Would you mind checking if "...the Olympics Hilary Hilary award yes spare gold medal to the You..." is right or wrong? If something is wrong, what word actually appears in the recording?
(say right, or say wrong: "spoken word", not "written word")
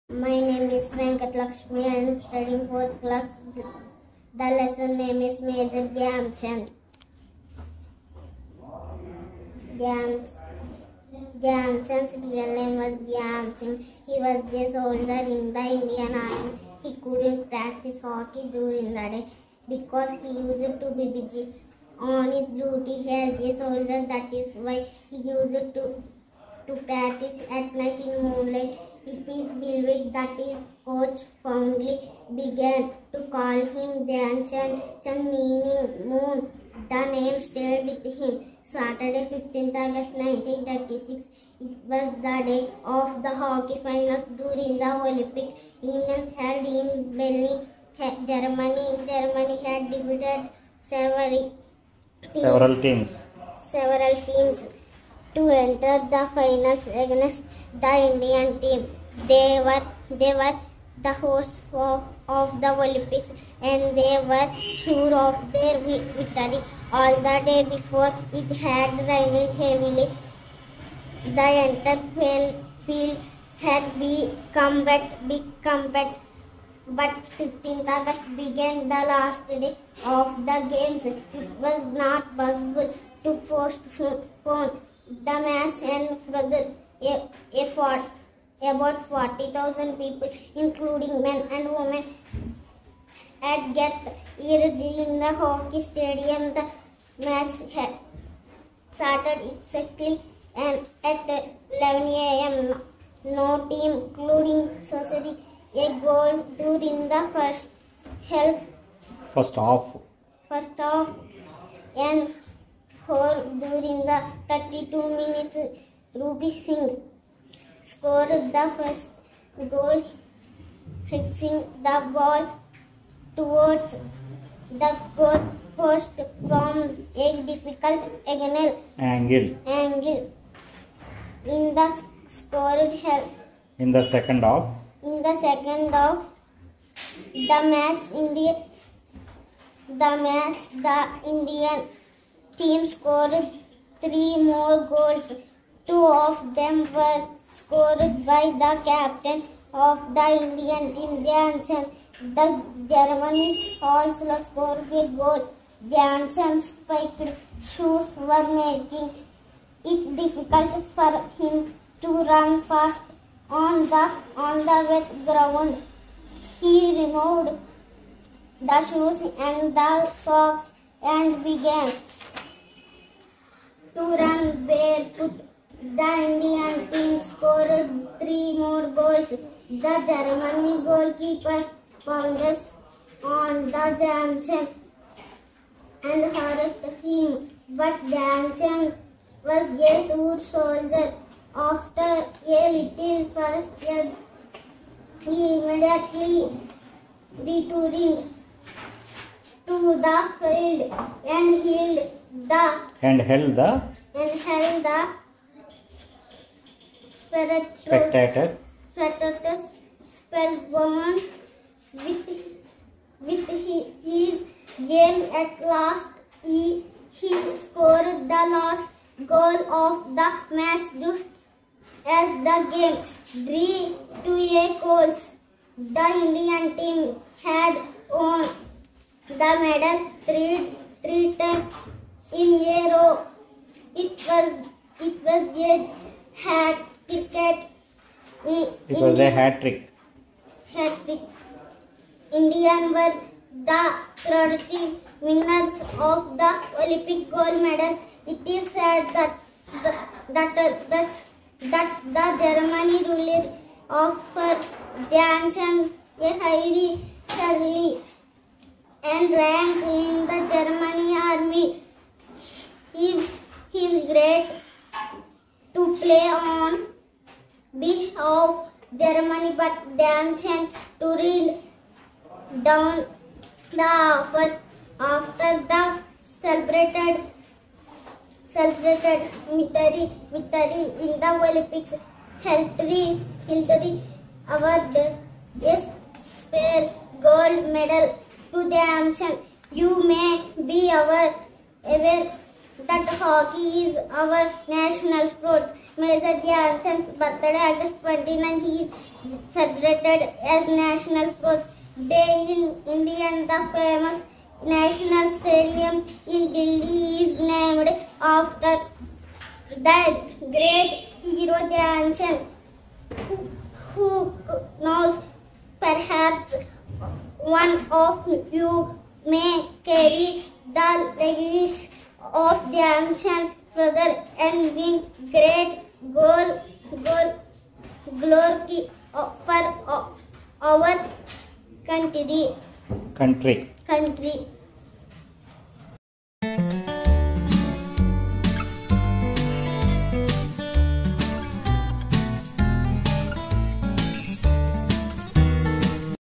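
right.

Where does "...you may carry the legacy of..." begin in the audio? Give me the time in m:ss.
5:18.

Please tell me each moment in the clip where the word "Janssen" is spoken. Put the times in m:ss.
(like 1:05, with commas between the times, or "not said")
3:04, 3:08.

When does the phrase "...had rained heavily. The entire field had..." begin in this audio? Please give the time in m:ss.
1:08.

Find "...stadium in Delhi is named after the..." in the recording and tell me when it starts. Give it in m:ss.
5:05.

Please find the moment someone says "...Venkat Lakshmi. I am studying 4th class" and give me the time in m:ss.
0:00.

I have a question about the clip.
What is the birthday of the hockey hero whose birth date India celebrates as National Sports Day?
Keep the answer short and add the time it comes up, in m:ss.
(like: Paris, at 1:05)
August 29, at 4:57.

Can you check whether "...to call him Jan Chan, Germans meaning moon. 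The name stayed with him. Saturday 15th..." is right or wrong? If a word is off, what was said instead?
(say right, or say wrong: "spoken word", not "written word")
wrong: "Chan", not "Germans".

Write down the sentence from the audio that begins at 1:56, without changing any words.
Ruby Singh scored the first goal, fixing the ball towards the goal post from a difficult angle.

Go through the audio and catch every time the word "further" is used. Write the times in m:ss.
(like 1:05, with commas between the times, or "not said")
1:26, 5:23.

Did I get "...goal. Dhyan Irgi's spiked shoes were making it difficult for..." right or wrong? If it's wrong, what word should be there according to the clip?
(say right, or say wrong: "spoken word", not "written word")
wrong: "Chand", not "Irgi".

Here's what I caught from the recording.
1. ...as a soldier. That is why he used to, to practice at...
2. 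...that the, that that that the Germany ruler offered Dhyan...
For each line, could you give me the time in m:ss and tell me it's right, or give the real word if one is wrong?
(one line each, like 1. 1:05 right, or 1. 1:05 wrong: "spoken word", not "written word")
1. 0:23 right
2. 4:09 right.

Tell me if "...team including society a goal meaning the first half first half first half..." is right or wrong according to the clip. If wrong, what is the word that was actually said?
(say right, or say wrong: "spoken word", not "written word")
wrong: "during", not "meaning".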